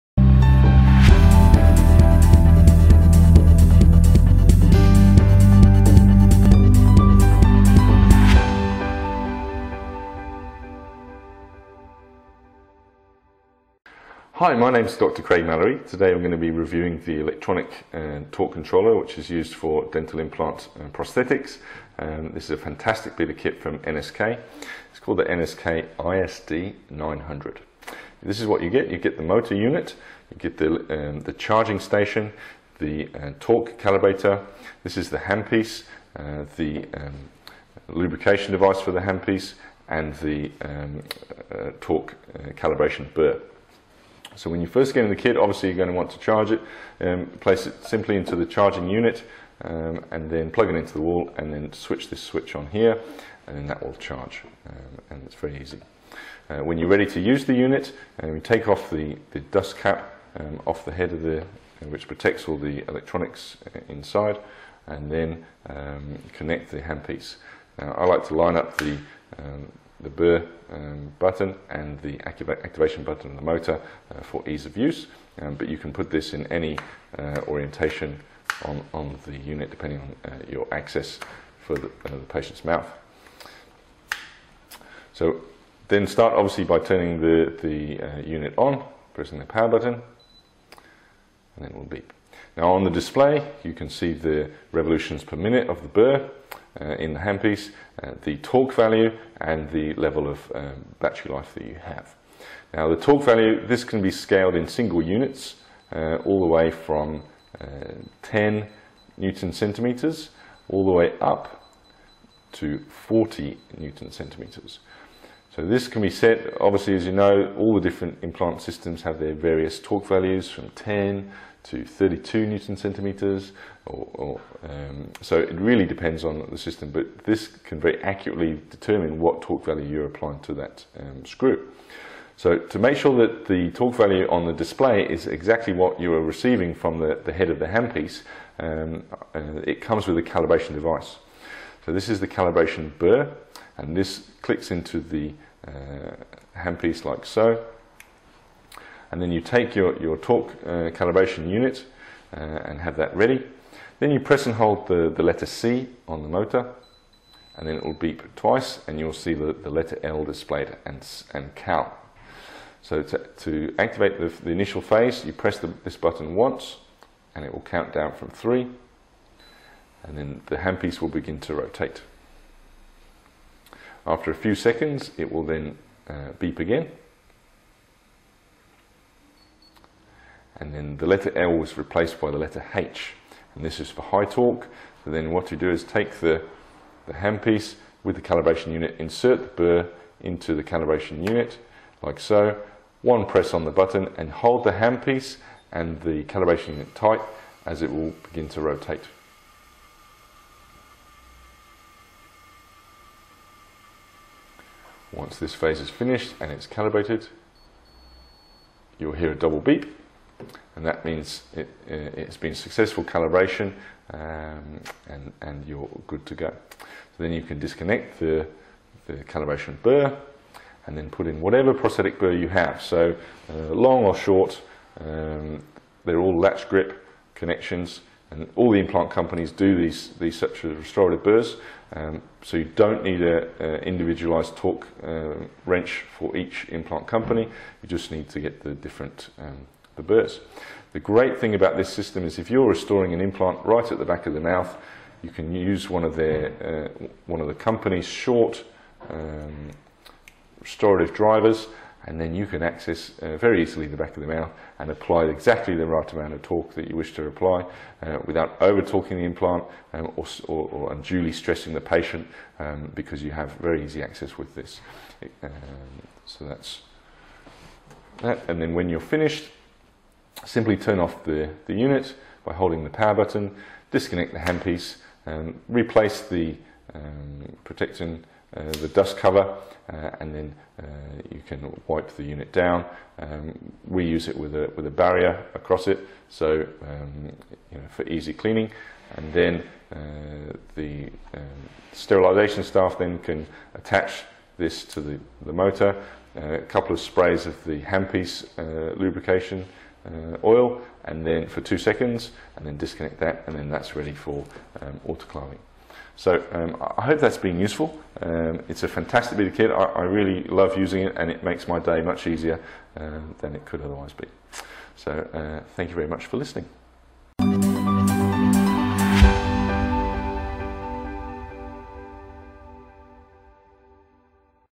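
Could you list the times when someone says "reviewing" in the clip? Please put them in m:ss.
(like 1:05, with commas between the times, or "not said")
0:16.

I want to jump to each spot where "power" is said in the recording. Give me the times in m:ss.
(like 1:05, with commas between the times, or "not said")
1:29, 4:32.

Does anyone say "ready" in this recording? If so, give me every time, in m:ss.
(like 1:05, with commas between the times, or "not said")
0:56, 2:33, 5:03.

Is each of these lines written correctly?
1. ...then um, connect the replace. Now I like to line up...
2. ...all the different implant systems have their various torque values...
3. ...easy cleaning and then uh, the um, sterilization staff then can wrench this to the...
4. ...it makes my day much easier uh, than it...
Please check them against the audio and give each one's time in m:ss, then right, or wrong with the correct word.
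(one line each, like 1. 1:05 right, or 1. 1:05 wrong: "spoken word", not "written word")
1. 1:05 wrong: "handpiece", not "replace"
2. 1:57 right
3. 4:48 wrong: "attach", not "wrench"
4. 5:11 right.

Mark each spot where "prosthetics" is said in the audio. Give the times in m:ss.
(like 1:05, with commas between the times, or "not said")
0:20, 3:41.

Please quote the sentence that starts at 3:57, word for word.
You just need to get the different um, the burrs.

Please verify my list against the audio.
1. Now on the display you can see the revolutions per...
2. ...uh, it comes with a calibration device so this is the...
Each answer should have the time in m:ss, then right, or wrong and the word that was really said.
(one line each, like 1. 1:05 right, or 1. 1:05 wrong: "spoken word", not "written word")
1. 1:32 right
2. 2:19 right.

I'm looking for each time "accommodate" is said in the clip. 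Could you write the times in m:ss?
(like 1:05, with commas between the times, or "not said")
not said.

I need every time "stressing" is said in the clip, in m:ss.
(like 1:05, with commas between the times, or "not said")
4:21.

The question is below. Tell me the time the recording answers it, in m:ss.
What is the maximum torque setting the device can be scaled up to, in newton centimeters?
1:53.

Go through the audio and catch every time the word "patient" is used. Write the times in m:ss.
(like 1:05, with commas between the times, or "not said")
1:22, 4:21.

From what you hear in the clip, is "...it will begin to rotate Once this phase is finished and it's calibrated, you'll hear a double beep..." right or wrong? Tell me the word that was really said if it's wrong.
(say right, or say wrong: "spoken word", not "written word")
right.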